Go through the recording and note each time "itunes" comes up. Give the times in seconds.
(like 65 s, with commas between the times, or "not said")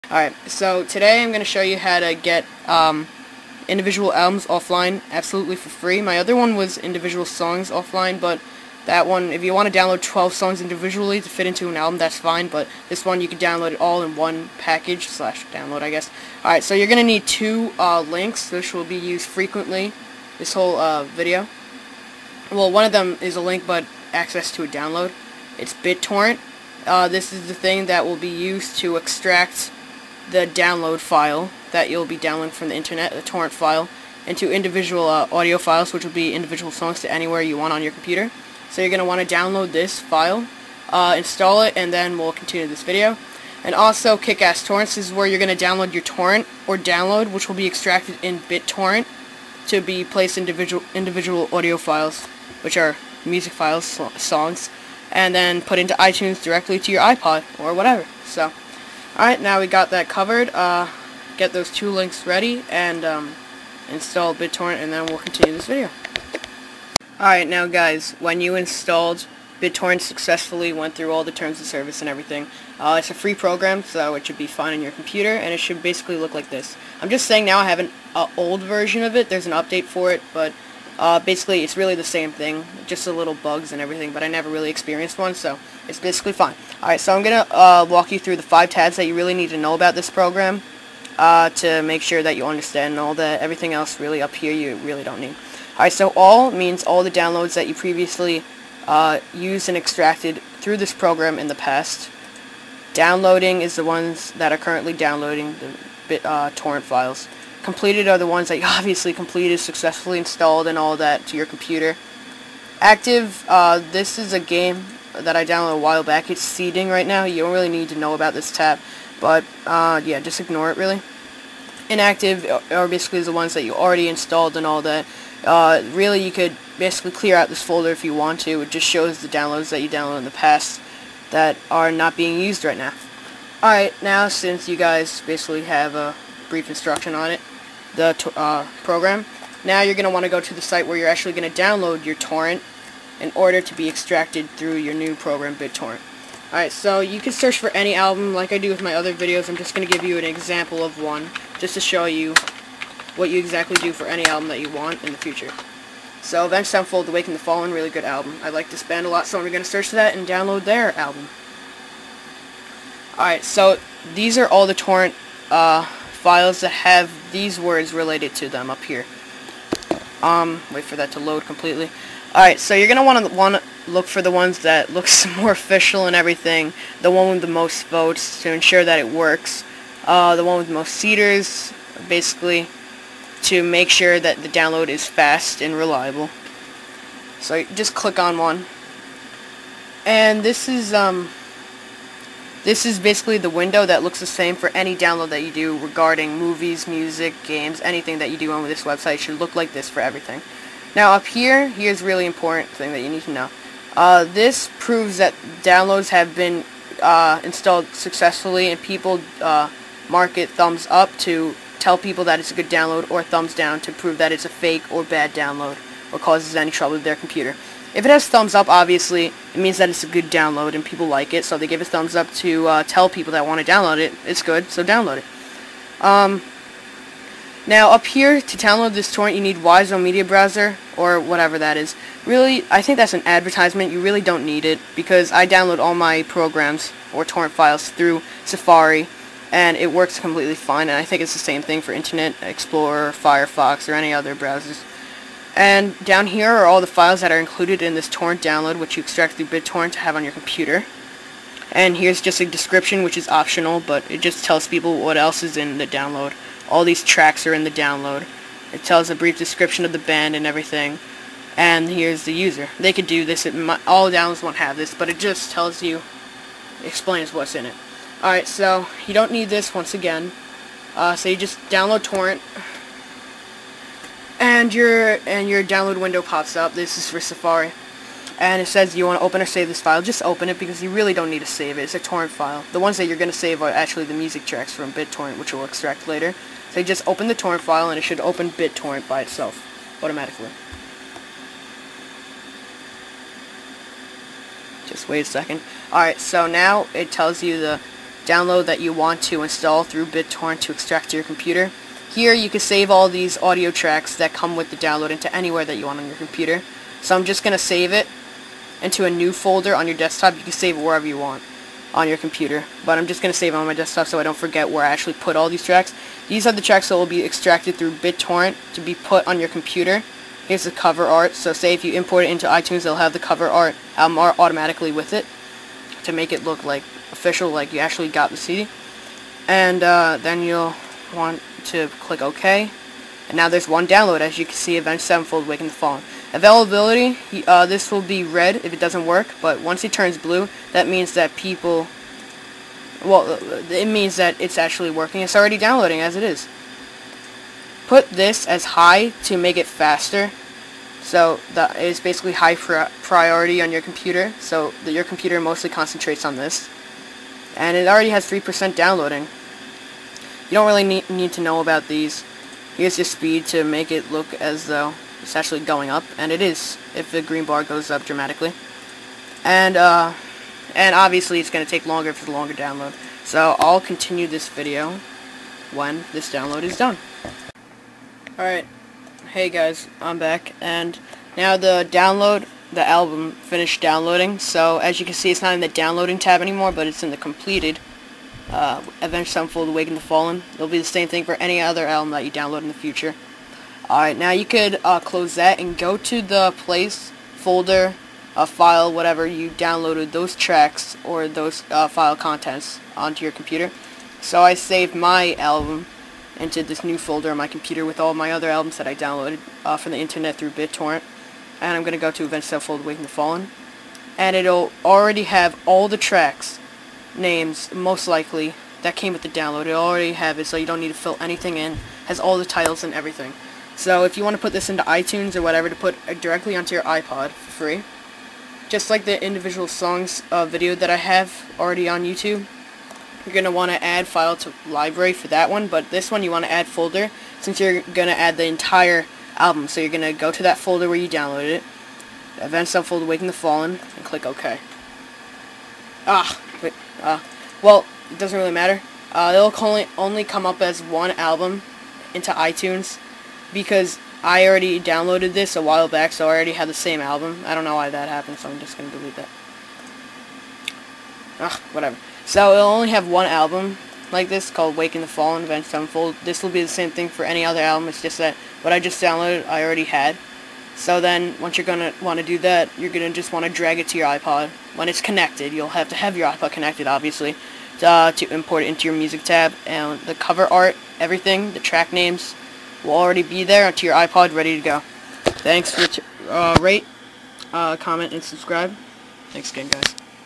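55 s, 322 s, 424 s, 452 s.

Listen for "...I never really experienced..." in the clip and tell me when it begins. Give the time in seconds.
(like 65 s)
84 s.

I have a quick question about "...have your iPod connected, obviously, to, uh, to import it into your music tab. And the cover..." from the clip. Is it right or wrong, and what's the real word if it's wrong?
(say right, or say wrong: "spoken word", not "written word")
right.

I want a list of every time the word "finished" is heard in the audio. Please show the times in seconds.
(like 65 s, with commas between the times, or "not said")
383 s.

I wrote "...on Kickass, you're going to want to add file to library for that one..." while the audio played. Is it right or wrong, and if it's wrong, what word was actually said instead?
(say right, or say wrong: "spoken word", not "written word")
wrong: "YouTube", not "Kickass".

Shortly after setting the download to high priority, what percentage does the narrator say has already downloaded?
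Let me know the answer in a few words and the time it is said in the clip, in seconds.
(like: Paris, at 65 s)
3%, at 358 s.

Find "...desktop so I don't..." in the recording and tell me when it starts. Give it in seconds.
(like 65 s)
313 s.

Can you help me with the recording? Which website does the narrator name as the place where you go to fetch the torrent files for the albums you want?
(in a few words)
Kickass Torrents.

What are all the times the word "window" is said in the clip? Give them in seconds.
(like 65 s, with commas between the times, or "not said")
193 s, 276 s.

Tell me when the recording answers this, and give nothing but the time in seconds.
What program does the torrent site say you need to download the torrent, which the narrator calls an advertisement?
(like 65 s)
229 s.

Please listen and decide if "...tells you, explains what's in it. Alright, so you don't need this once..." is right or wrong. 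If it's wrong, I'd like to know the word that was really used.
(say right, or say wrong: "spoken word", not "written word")
right.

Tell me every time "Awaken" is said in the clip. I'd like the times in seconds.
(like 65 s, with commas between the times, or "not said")
157 s, 389 s, 412 s.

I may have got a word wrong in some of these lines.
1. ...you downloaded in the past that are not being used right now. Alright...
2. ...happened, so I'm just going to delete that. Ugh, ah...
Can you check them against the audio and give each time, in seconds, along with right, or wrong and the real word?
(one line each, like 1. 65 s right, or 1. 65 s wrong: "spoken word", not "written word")
1. 129 s right
2. 458 s right.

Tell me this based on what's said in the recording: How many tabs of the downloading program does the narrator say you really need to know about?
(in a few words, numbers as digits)
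5.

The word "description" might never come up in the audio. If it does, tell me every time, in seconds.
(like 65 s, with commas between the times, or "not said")
252 s, 259 s.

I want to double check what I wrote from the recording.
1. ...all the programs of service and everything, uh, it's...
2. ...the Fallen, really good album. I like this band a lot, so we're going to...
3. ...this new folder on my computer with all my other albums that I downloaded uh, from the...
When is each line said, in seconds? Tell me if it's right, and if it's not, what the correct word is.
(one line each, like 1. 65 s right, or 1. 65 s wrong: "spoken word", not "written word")
1. 71 s wrong: "terms", not "programs"
2. 157 s right
3. 406 s right.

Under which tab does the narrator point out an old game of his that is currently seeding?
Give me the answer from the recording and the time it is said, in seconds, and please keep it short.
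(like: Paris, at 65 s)
Active, at 112 s.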